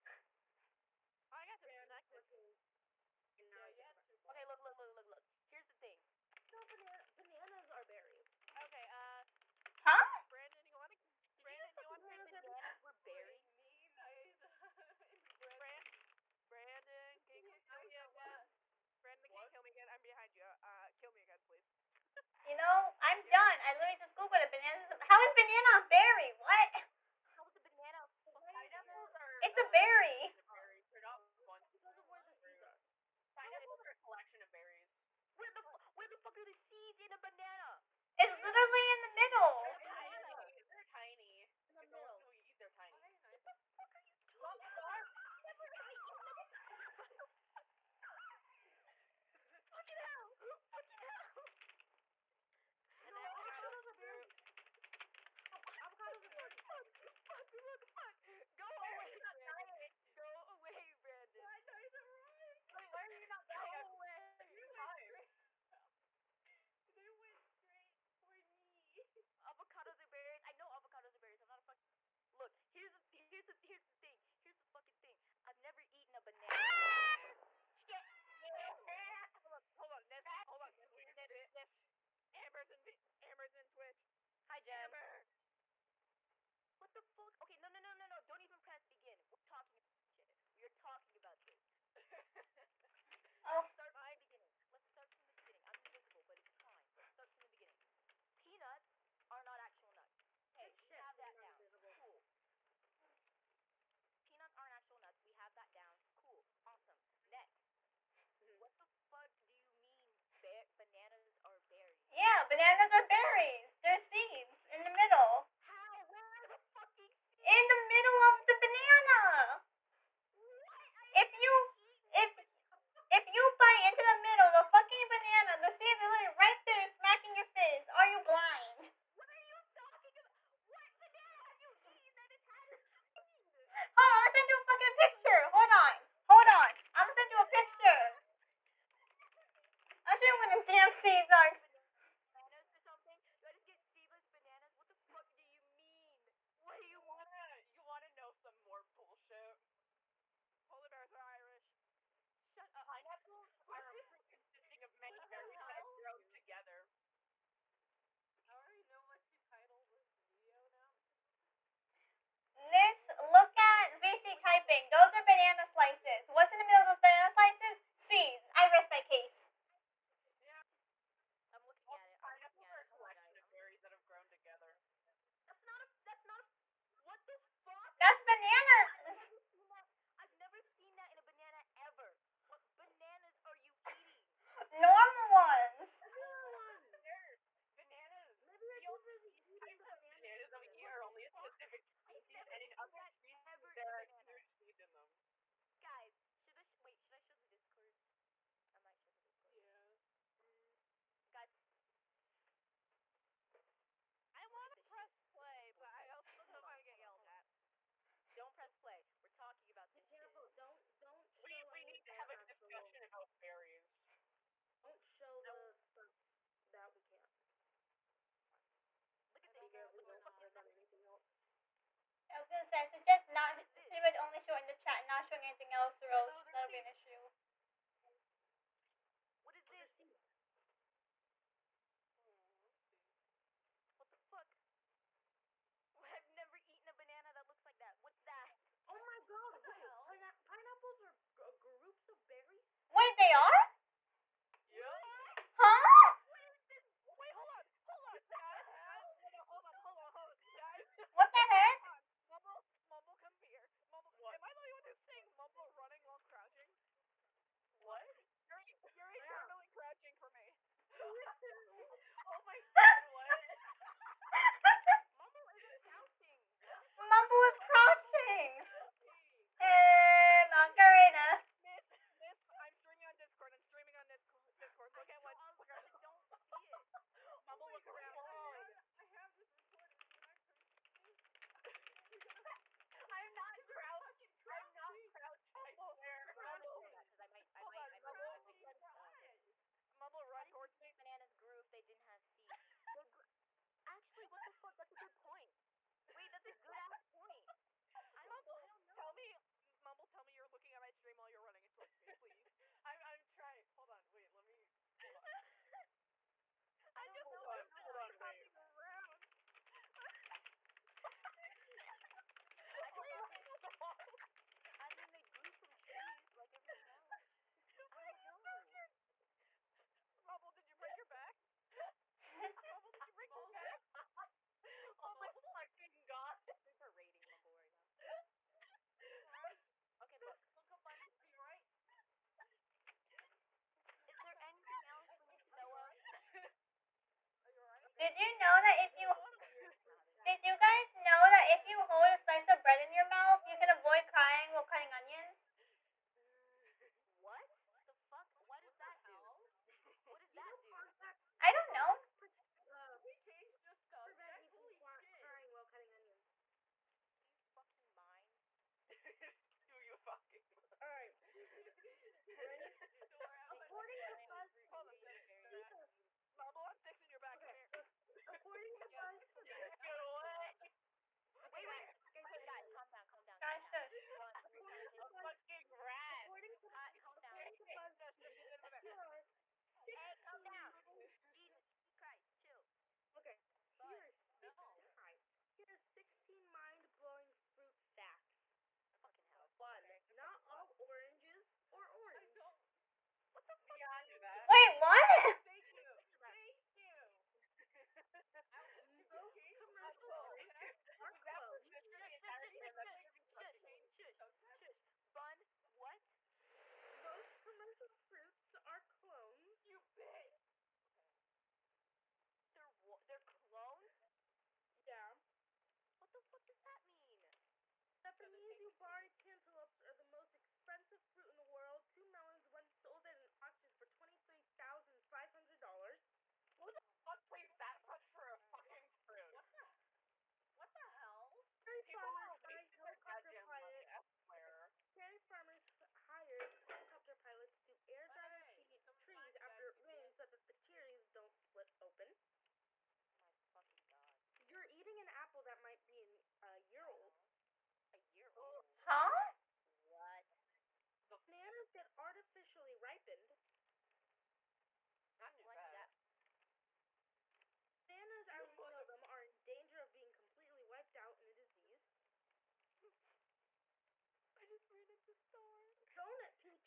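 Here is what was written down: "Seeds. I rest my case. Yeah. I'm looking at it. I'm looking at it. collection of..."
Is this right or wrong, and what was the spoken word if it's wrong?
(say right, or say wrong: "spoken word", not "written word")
right.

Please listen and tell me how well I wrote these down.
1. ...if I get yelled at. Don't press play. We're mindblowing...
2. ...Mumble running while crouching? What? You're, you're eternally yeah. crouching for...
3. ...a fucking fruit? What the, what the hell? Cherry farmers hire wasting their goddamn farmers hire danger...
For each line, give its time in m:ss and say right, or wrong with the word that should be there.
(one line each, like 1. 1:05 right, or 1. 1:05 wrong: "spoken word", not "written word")
1. 3:26 wrong: "talking", not "mindblowing"
2. 4:15 right
3. 7:08 wrong: "helicopter", not "danger".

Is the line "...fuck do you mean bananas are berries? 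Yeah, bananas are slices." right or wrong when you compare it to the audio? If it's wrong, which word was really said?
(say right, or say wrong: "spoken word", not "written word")
wrong: "berries", not "slices".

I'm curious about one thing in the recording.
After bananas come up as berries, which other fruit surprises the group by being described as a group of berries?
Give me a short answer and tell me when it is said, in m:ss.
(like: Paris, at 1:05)
Pineapples, at 4:00.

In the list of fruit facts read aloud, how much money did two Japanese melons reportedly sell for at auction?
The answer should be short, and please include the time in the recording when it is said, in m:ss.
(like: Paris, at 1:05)
$23,500, at 7:03.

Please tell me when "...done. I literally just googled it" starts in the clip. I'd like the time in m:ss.
0:23.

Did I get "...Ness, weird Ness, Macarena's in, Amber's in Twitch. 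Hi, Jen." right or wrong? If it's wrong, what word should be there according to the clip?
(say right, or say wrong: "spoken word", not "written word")
wrong: "Amber", not "Macarena".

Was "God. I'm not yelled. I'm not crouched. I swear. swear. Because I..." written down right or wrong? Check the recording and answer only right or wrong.
wrong.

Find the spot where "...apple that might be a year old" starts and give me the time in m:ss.
7:25.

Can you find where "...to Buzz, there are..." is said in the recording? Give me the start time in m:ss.
6:17.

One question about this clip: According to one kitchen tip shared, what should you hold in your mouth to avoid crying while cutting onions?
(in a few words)
A slice of bread.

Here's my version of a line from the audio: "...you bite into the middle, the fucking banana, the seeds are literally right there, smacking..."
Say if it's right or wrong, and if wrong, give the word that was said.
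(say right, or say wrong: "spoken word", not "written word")
right.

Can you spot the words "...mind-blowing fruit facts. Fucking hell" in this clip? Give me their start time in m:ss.
6:26.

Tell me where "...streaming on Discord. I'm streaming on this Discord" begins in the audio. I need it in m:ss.
4:32.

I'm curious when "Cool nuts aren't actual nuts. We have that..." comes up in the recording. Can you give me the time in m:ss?
1:41.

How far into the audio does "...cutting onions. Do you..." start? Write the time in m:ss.
5:55.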